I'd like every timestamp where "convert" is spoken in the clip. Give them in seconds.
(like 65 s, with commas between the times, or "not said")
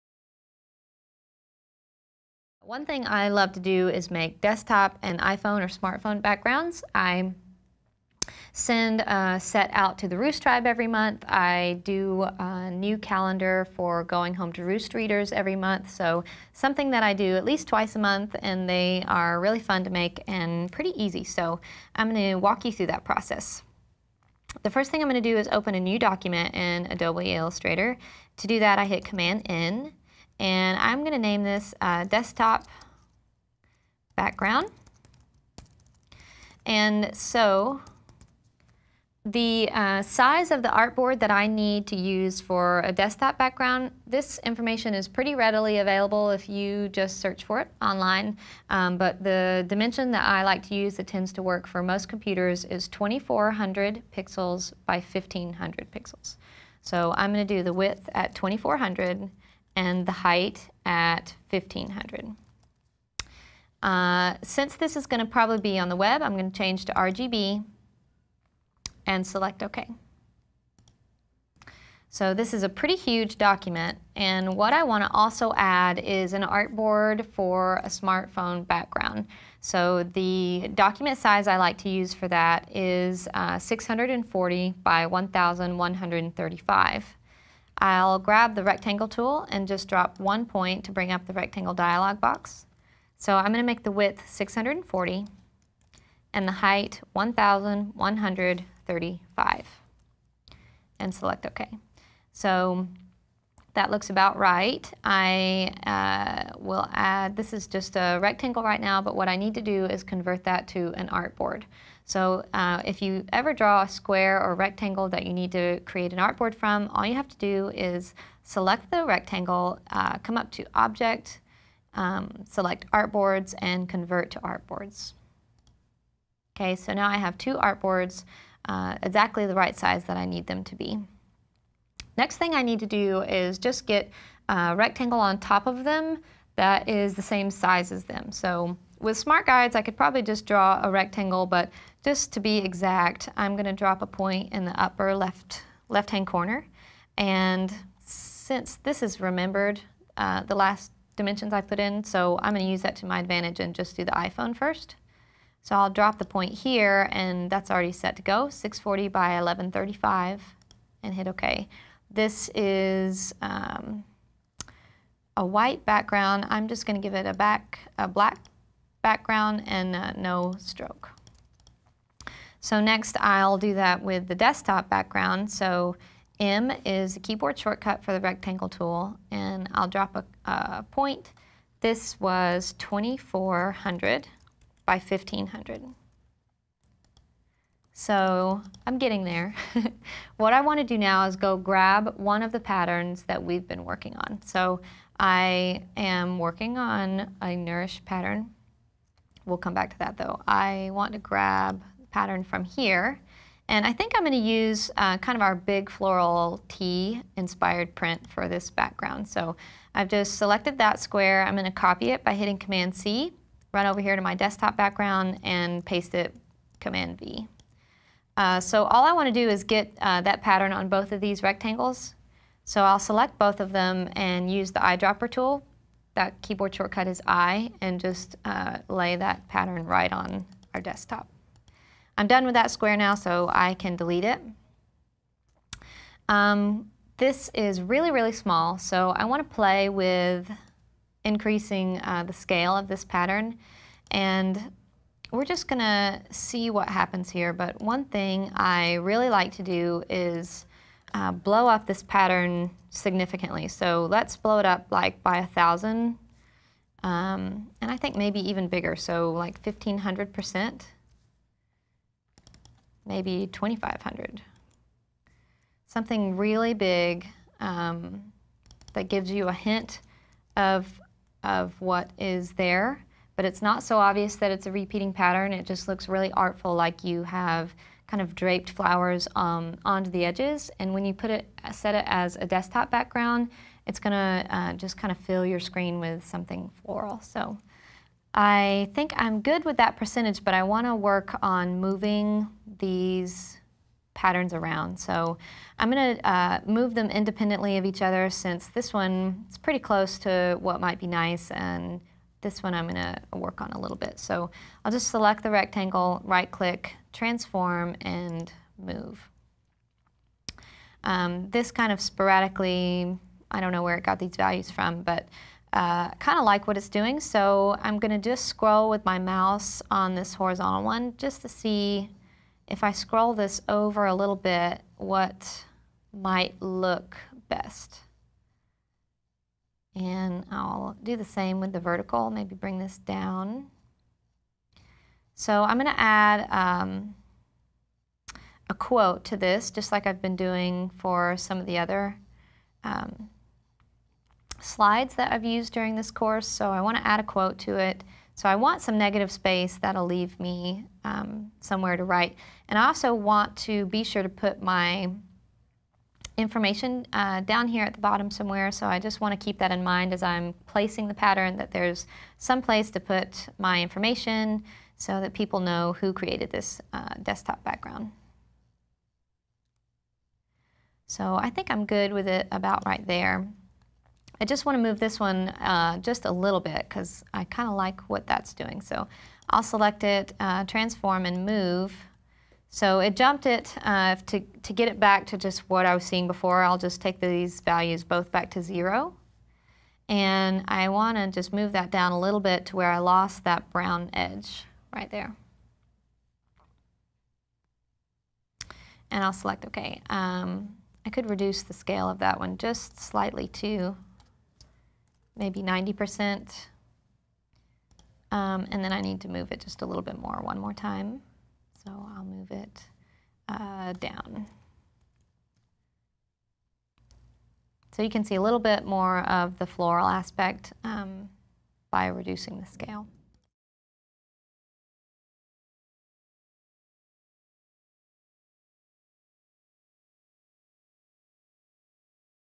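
110 s, 123 s.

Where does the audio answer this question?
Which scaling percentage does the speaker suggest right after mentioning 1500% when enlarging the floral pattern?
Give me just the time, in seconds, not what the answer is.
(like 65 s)
263 s.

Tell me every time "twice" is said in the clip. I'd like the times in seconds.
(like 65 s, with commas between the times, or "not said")
17 s.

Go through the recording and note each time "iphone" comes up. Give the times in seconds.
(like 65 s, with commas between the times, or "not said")
5 s, 154 s.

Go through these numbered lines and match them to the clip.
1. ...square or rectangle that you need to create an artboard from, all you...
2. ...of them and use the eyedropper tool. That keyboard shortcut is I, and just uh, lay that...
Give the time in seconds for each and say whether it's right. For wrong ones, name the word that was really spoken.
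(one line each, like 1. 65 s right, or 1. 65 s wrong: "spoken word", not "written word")
1. 113 s right
2. 223 s right.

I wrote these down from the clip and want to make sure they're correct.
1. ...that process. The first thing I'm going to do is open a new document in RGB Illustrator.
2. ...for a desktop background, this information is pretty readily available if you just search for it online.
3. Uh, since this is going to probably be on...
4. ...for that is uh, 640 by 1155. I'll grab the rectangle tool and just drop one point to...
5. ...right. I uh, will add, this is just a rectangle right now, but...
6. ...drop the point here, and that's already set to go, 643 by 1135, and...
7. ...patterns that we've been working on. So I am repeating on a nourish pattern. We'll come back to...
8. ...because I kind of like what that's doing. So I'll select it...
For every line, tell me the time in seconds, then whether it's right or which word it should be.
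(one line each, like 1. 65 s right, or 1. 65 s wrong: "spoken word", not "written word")
1. 22 s wrong: "Adobe", not "RGB"
2. 42 s right
3. 63 s right
4. 82 s wrong: "1135", not "1155"
5. 104 s right
6. 155 s wrong: "640", not "643"
7. 192 s wrong: "working", not "repeating"
8. 376 s right.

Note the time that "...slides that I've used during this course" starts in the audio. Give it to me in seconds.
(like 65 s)
344 s.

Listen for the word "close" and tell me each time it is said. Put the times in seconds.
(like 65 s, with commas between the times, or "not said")
299 s.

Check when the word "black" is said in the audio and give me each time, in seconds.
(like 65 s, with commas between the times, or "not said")
168 s.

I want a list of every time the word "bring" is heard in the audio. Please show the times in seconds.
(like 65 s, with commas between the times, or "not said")
90 s, 332 s.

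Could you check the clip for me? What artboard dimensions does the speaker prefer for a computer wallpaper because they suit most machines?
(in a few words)
2400 by 1500 pixels.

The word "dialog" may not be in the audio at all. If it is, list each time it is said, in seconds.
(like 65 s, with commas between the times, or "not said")
91 s.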